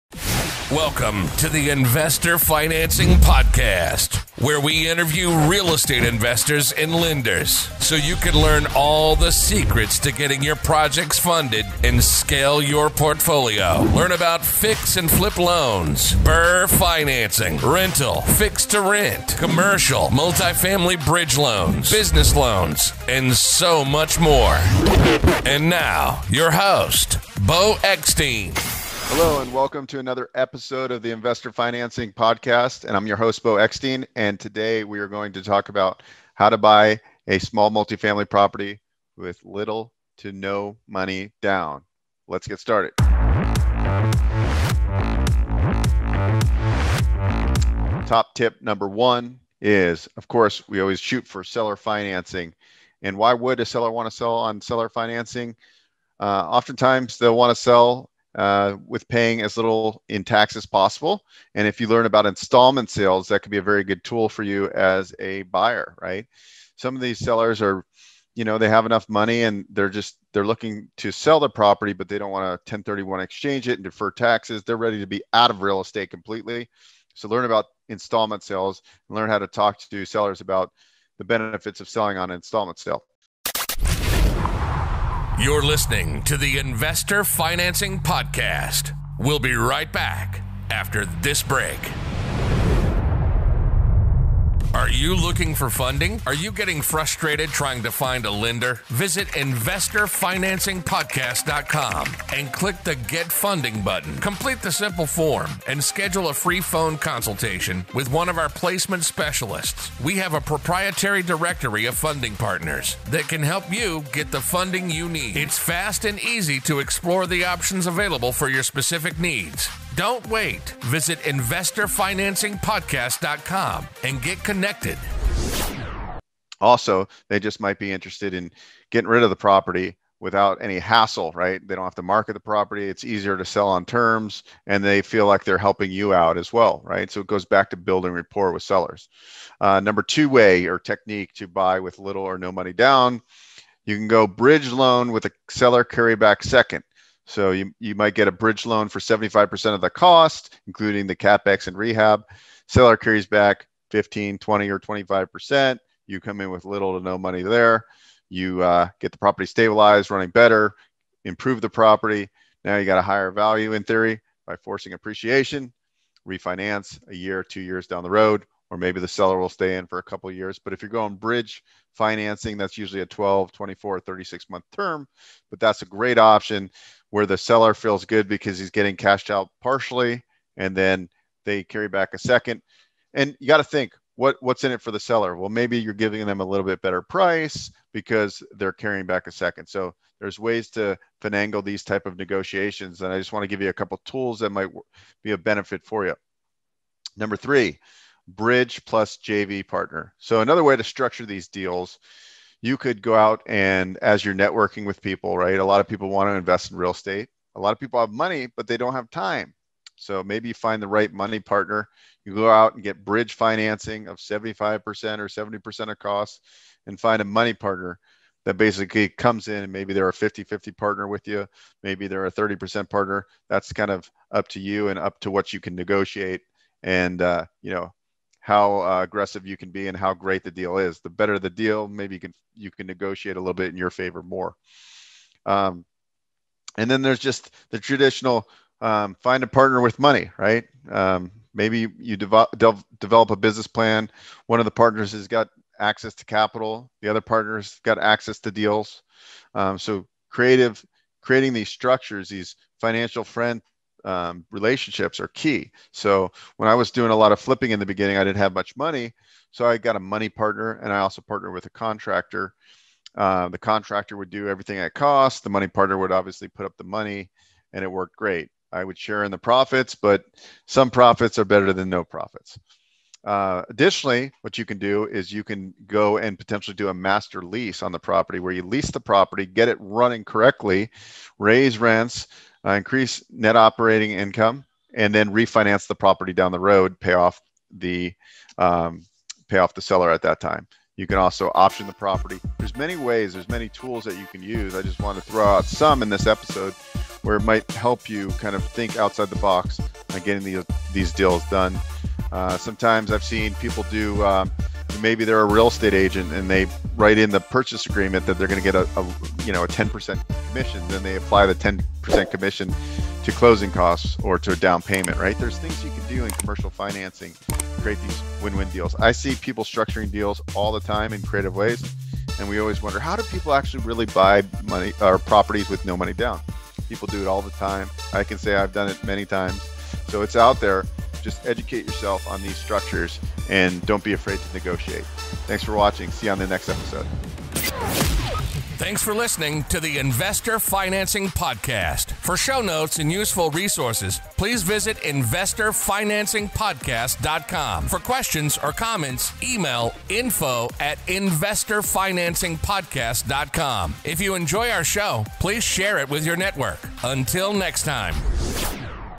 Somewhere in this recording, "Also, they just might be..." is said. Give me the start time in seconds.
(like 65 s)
126 s.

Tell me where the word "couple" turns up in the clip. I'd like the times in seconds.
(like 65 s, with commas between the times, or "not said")
170 s, 193 s.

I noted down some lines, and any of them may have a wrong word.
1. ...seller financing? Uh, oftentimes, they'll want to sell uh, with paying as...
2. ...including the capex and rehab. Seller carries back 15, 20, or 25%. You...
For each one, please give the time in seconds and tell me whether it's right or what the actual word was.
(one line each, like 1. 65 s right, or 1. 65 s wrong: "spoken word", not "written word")
1. 54 s right
2. 150 s right.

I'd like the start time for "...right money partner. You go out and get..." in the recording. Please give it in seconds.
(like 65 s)
210 s.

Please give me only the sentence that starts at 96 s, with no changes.
Are you getting frustrated trying to find a lender?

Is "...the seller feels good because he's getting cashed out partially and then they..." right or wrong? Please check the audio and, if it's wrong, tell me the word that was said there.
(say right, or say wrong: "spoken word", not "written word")
right.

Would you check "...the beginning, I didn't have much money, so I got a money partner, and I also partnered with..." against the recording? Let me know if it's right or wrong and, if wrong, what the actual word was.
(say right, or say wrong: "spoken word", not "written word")
right.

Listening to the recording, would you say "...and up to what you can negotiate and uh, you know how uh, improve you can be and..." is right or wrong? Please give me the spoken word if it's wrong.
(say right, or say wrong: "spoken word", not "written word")
wrong: "aggressive", not "improve".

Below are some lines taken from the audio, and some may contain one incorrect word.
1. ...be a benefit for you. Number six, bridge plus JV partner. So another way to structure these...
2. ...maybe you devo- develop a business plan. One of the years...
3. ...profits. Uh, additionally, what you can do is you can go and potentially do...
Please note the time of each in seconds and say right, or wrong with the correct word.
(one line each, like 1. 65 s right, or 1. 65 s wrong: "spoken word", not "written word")
1. 195 s wrong: "three", not "six"
2. 241 s wrong: "partners", not "years"
3. 272 s right.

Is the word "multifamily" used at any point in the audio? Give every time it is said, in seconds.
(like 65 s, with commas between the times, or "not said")
20 s, 37 s.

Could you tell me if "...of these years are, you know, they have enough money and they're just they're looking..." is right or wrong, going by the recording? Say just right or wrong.
wrong.